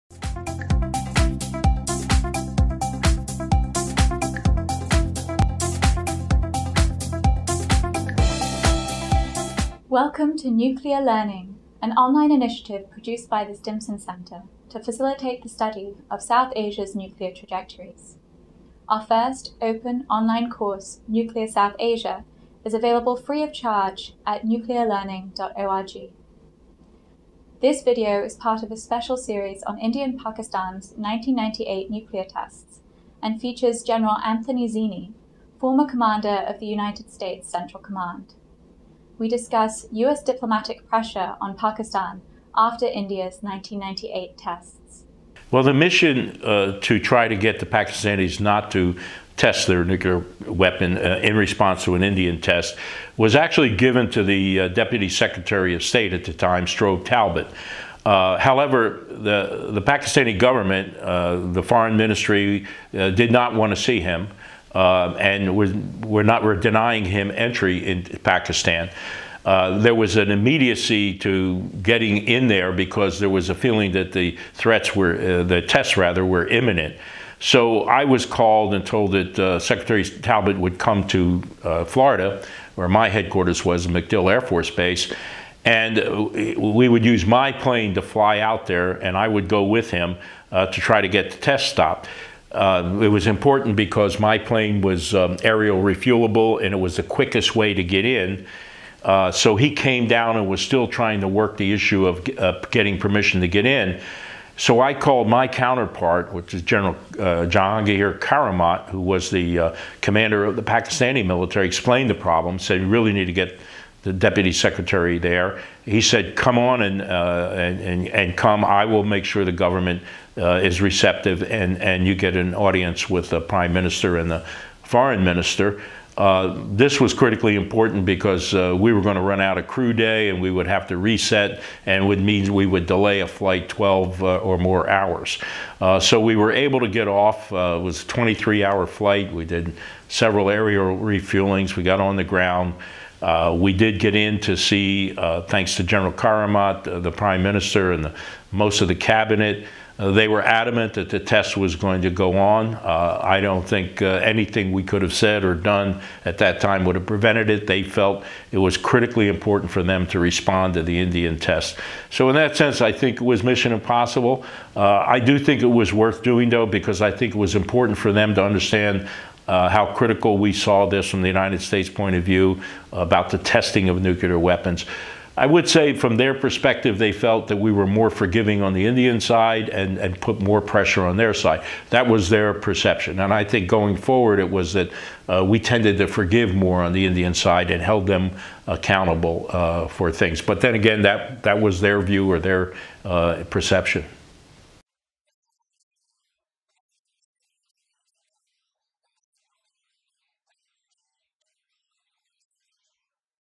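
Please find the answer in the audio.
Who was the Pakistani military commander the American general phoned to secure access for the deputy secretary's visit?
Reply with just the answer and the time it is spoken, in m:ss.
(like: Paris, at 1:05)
Jahangir Karamat, at 1:47.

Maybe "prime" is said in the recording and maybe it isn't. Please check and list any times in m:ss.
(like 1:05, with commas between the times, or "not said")
2:03, 2:27.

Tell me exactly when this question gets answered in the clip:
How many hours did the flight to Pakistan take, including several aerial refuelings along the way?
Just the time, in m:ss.
2:18.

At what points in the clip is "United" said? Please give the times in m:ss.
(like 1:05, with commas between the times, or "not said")
0:36, 2:51.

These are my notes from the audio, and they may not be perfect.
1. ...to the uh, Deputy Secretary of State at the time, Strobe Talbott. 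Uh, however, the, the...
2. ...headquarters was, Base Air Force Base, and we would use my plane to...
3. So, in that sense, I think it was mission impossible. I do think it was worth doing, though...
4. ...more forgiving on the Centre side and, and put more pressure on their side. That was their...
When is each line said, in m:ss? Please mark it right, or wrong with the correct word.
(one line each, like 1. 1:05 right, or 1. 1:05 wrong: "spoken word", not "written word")
1. 0:54 right
2. 1:23 wrong: "MacDill", not "Base"
3. 2:42 right
4. 2:57 wrong: "Indian", not "Centre".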